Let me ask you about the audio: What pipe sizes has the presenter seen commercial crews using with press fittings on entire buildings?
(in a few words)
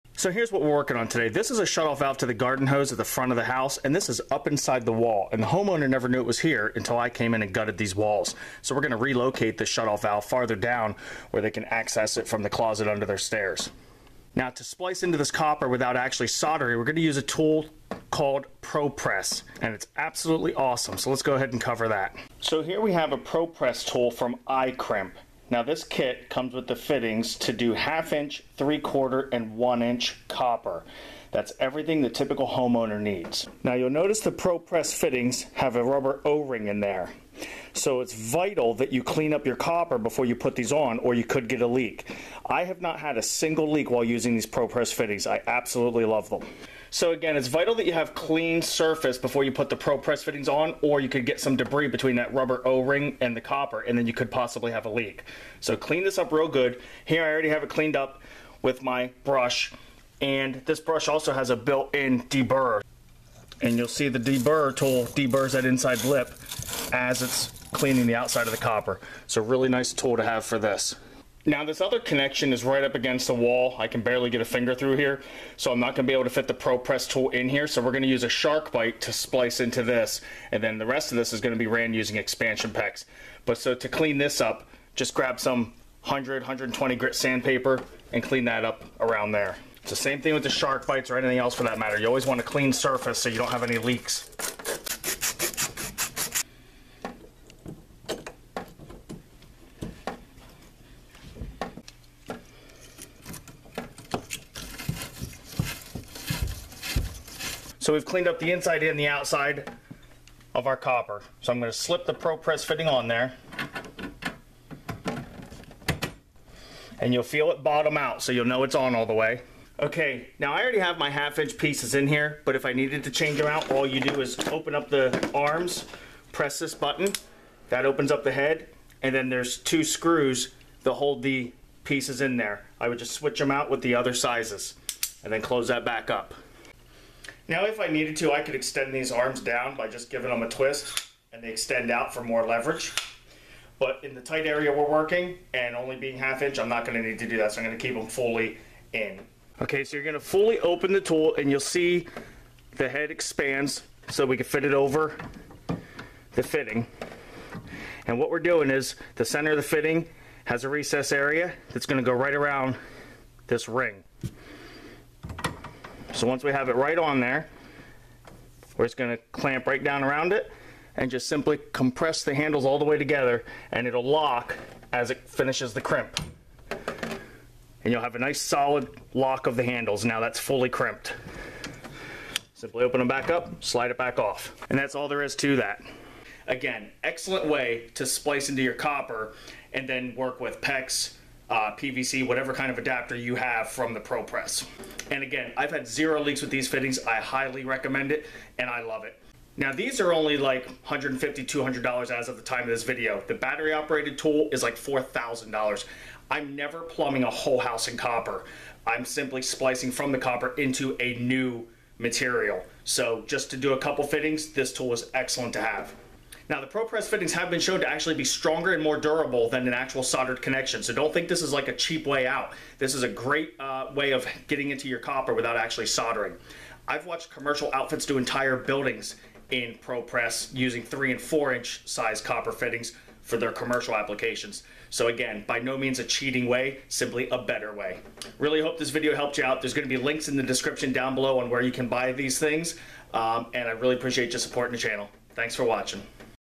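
3 and 4 inch.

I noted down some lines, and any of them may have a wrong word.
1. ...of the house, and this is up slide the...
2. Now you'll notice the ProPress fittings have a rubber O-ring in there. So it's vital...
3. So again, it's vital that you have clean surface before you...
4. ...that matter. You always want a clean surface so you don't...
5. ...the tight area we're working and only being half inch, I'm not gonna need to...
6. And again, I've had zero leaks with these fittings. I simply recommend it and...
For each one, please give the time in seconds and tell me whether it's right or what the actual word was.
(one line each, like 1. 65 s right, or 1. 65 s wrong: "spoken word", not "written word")
1. 3 s wrong: "inside", not "slide"
2. 33 s right
3. 46 s right
4. 91 s right
5. 144 s right
6. 195 s wrong: "highly", not "simply".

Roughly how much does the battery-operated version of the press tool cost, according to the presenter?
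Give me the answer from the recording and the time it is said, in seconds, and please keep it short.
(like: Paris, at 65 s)
$4,000, at 204 s.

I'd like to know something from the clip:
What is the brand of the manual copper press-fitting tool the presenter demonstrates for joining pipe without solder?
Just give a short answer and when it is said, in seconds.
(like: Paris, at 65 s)
iCrimp, at 24 s.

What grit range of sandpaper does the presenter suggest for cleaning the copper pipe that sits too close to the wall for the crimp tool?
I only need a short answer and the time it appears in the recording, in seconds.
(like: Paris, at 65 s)
100 to 120 grit, at 86 s.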